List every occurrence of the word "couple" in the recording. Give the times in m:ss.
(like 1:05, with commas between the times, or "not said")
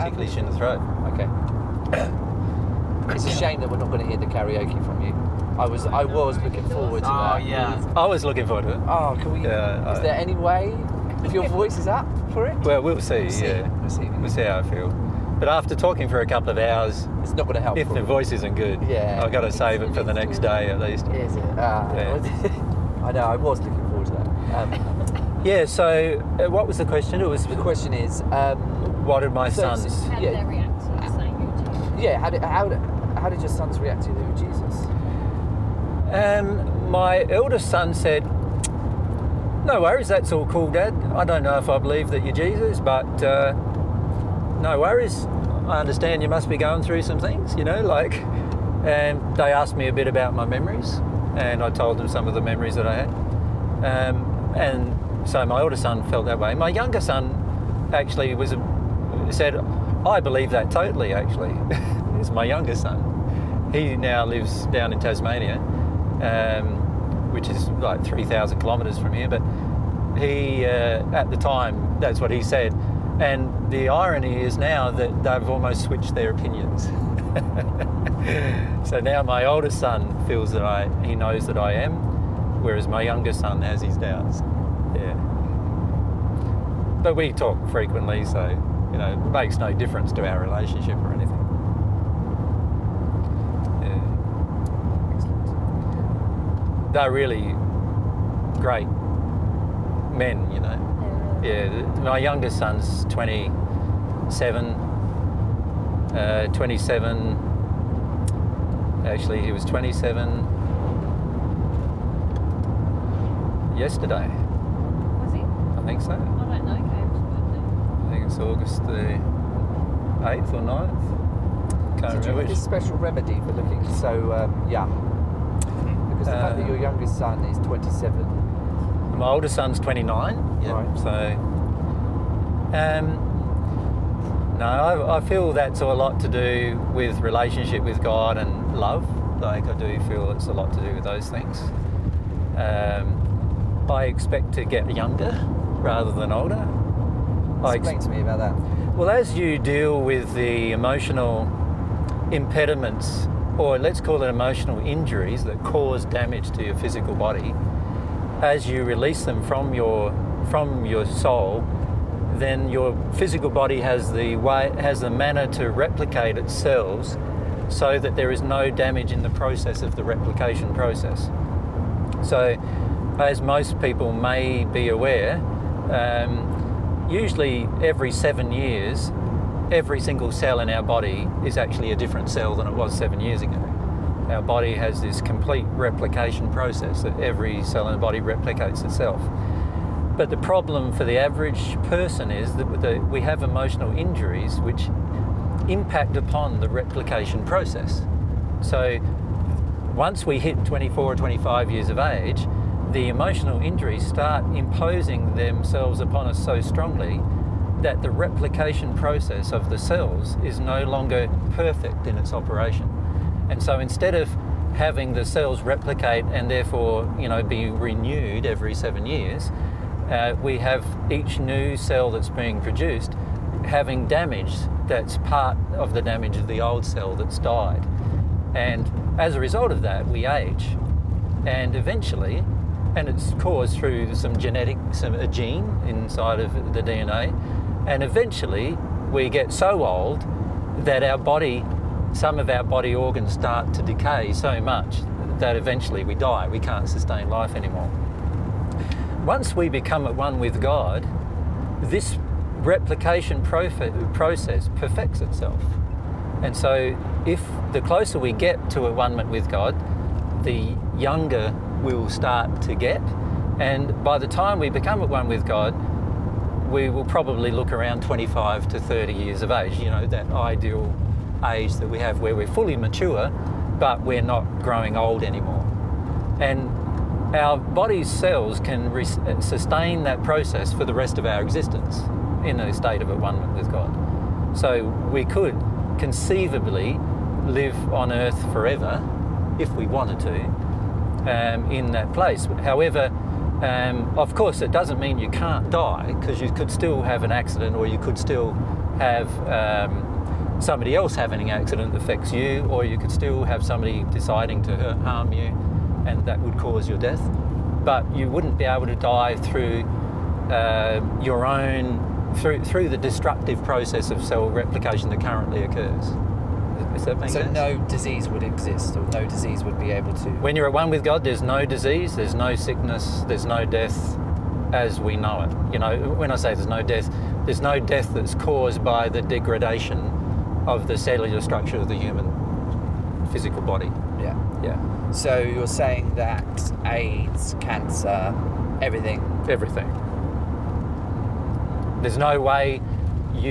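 0:16.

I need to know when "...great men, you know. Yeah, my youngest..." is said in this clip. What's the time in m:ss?
1:38.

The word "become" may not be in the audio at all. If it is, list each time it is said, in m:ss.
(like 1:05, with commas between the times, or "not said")
4:09, 4:24.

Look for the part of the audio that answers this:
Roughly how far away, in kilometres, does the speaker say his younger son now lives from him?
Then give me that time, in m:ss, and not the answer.
1:08.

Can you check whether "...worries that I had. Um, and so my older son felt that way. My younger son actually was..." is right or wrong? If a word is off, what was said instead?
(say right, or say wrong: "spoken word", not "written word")
wrong: "memories", not "worries".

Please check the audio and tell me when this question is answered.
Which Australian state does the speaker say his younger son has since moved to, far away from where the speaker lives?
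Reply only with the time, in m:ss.
1:04.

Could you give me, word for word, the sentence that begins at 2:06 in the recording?
Because the fact that your uh, youngest son is 27.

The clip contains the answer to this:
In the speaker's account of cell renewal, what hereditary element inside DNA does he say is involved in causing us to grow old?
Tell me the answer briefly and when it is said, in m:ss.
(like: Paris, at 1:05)
a gene, at 3:55.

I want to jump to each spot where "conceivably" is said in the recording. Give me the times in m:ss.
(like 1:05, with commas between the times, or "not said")
4:45.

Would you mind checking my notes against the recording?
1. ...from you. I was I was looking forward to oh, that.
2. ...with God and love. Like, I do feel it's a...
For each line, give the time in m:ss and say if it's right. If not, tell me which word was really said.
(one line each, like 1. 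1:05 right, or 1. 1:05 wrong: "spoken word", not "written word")
1. 0:04 right
2. 2:17 right.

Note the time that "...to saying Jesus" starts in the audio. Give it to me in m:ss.
0:30.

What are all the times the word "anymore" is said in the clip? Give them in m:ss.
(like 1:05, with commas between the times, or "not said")
4:07, 4:35.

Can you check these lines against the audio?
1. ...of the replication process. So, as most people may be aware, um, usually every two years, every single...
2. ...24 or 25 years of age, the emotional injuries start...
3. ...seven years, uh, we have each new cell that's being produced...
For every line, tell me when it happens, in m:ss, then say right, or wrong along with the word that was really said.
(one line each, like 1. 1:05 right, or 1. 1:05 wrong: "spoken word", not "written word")
1. 2:49 wrong: "seven", not "two"
2. 3:20 right
3. 3:38 right.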